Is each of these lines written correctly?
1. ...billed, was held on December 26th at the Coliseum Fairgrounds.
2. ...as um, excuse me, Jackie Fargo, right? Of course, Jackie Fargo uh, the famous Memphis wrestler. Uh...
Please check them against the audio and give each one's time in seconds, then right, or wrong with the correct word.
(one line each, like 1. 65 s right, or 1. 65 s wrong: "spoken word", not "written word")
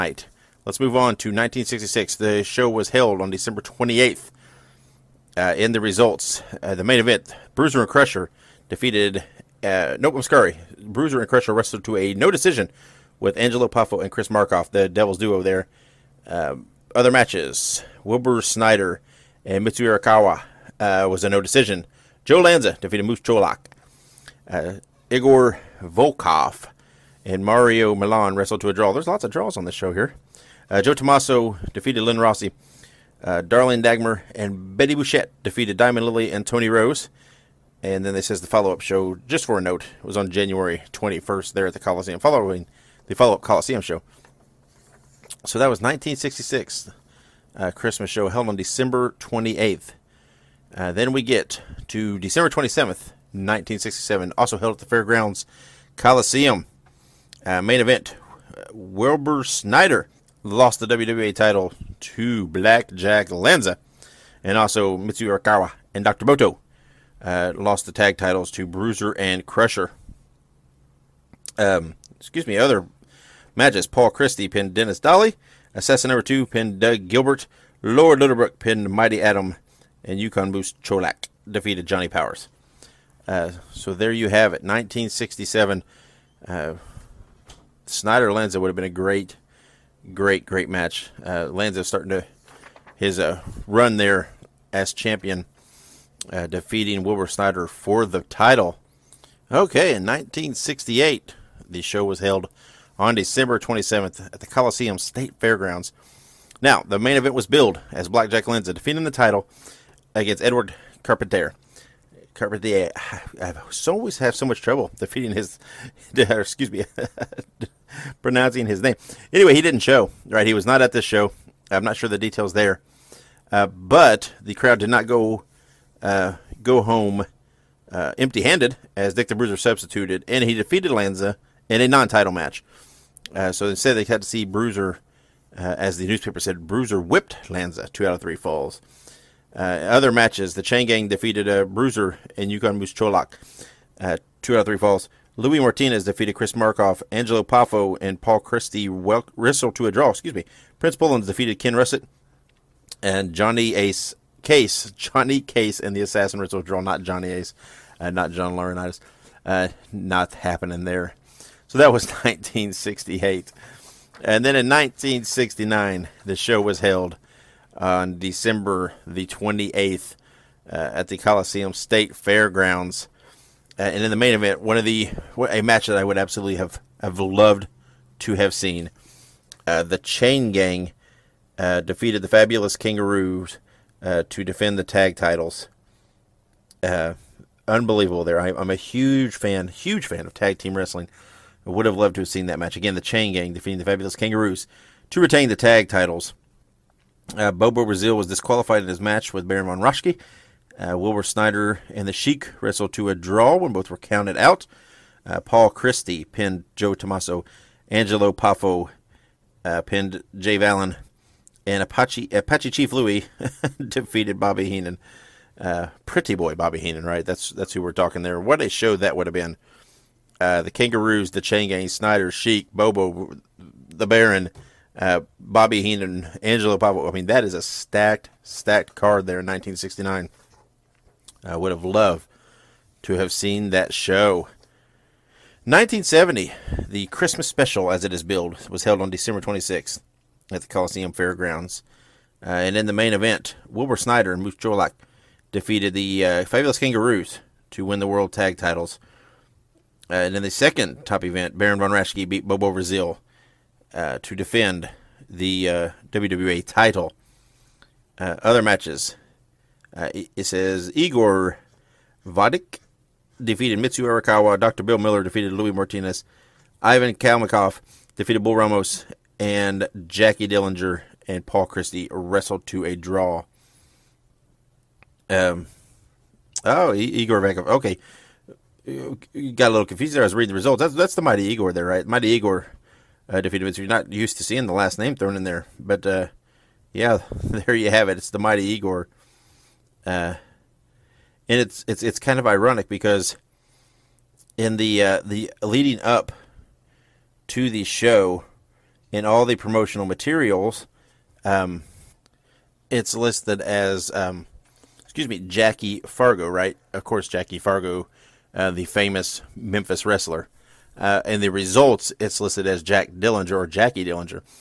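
1. 238 s right
2. 303 s right.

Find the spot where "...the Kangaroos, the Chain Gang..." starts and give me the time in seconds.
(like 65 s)
220 s.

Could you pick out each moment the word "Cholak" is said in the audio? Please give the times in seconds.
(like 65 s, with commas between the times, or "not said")
23 s, 80 s, 142 s, 244 s.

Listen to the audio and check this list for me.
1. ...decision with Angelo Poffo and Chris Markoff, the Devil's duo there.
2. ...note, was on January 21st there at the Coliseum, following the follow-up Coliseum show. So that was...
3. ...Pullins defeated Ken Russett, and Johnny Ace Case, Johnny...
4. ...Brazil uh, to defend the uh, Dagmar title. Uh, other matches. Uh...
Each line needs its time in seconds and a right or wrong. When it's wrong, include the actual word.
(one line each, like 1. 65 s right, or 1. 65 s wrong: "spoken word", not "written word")
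1. 12 s right
2. 39 s right
3. 150 s right
4. 252 s wrong: "WWE", not "Dagmar".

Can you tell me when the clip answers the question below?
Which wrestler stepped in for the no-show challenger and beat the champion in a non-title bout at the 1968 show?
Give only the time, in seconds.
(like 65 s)
129 s.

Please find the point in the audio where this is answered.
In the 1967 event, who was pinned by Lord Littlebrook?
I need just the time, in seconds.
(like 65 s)
77 s.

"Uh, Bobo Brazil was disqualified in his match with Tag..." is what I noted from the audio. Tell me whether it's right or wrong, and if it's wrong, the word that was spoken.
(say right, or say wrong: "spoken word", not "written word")
wrong: "Baron", not "Tag".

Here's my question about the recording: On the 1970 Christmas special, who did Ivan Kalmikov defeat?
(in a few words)
Bull Ramos.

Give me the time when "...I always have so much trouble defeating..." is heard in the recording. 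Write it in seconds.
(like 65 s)
113 s.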